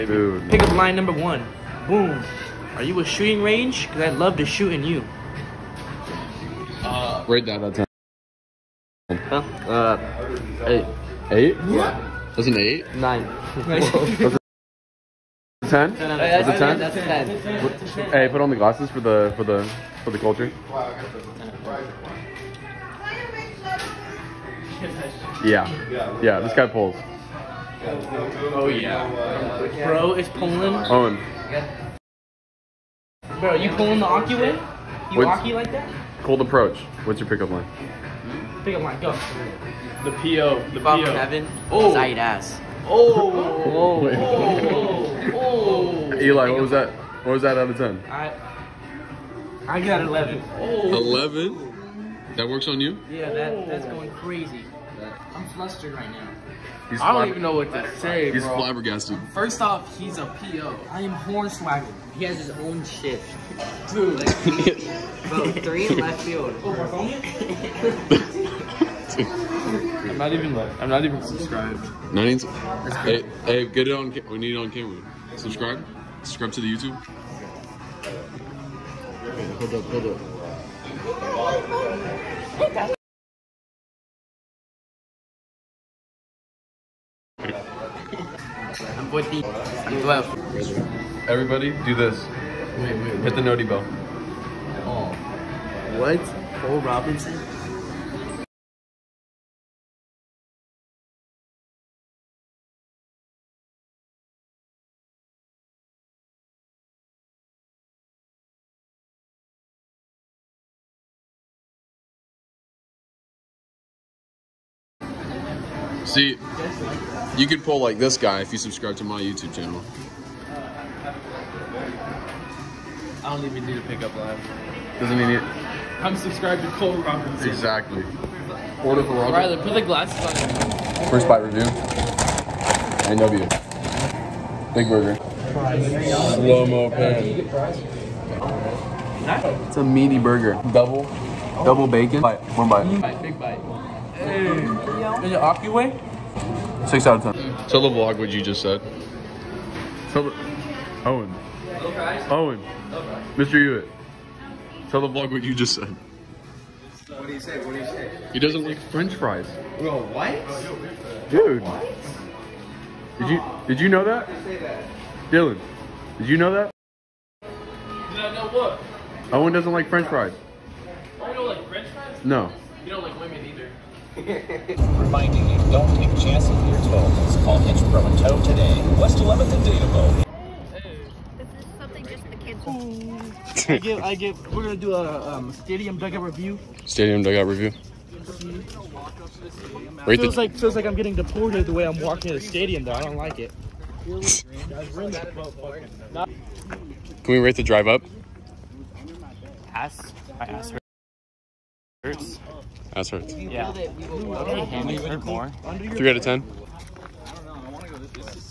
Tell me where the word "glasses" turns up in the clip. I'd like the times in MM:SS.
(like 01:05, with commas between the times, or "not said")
00:18, 02:09.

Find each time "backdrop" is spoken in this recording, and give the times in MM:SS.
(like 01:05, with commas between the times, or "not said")
not said.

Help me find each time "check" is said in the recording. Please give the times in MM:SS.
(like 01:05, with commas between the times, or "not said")
not said.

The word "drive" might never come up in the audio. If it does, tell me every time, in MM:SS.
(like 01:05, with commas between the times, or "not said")
03:17.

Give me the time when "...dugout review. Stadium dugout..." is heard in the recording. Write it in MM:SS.
03:05.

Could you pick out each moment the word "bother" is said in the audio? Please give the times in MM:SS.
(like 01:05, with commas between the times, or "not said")
not said.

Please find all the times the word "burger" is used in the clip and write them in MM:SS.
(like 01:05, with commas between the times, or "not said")
02:14, 02:20.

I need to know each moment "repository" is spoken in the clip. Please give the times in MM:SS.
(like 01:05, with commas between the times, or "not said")
not said.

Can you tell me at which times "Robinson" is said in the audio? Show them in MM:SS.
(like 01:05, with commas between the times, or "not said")
01:36, 02:07.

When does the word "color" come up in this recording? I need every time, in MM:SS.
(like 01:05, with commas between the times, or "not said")
not said.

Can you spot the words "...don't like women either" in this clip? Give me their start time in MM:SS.
02:52.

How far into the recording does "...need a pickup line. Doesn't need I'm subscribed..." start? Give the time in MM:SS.
02:03.